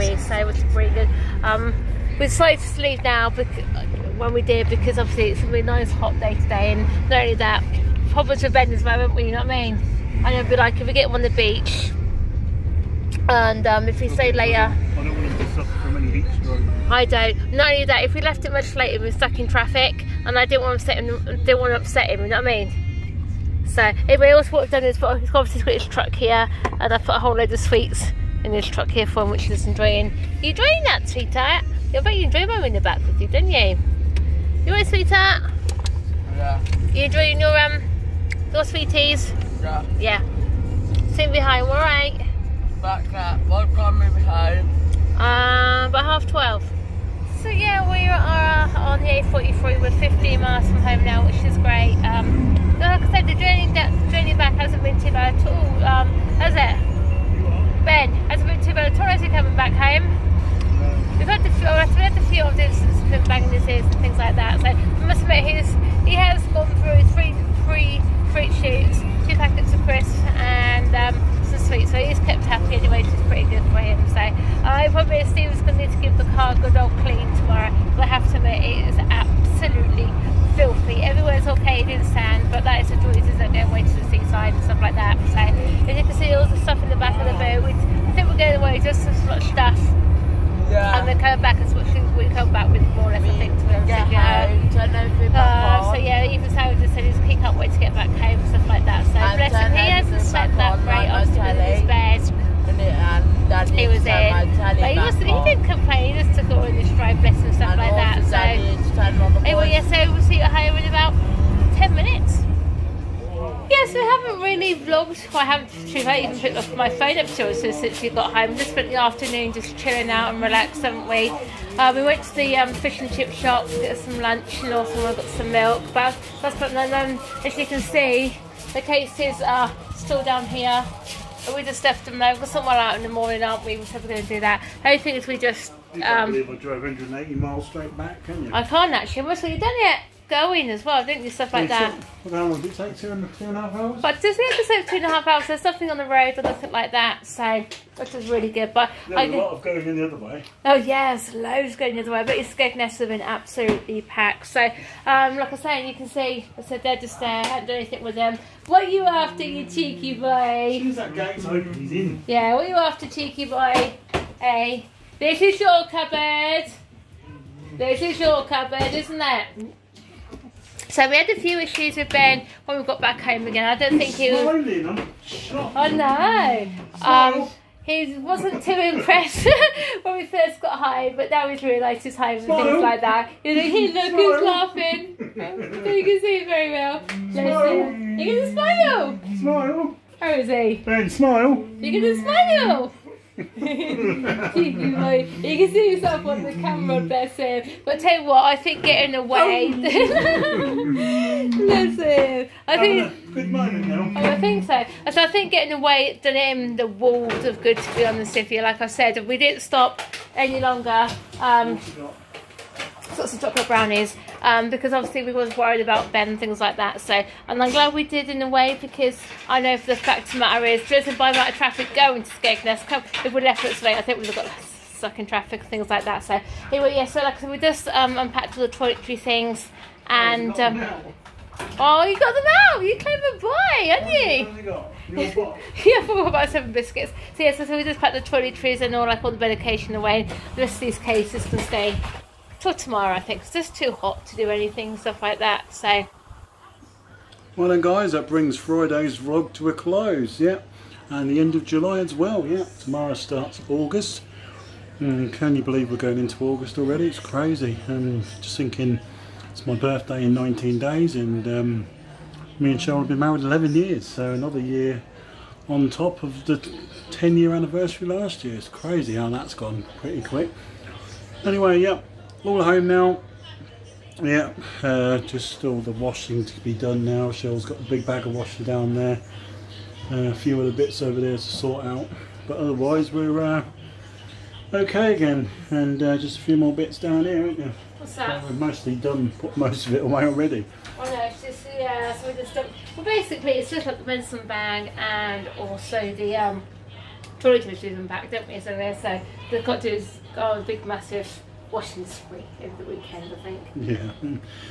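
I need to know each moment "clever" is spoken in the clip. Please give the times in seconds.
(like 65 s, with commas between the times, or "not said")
232 s.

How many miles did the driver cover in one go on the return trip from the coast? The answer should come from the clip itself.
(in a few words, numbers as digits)
180.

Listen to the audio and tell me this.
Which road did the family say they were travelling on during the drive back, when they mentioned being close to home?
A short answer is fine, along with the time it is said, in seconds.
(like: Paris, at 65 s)
A43, at 49 s.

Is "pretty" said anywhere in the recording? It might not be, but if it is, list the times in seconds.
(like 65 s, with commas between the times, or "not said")
0 s, 269 s.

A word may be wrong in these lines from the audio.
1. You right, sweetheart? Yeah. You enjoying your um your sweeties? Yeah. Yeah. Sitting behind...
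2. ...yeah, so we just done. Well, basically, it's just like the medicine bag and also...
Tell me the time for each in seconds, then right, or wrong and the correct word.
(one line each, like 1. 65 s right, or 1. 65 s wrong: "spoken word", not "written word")
1. 34 s right
2. 291 s right.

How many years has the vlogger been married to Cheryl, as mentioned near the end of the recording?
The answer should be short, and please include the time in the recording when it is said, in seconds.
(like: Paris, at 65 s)
11, at 263 s.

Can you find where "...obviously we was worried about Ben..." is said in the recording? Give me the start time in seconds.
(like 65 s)
214 s.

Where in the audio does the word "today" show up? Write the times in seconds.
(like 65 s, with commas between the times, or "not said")
6 s, 223 s.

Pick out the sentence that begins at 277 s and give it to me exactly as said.
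Cheryl's got a big bag of washing down there.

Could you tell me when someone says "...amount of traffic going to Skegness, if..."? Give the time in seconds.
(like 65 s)
221 s.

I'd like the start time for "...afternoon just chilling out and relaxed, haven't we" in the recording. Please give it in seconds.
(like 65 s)
118 s.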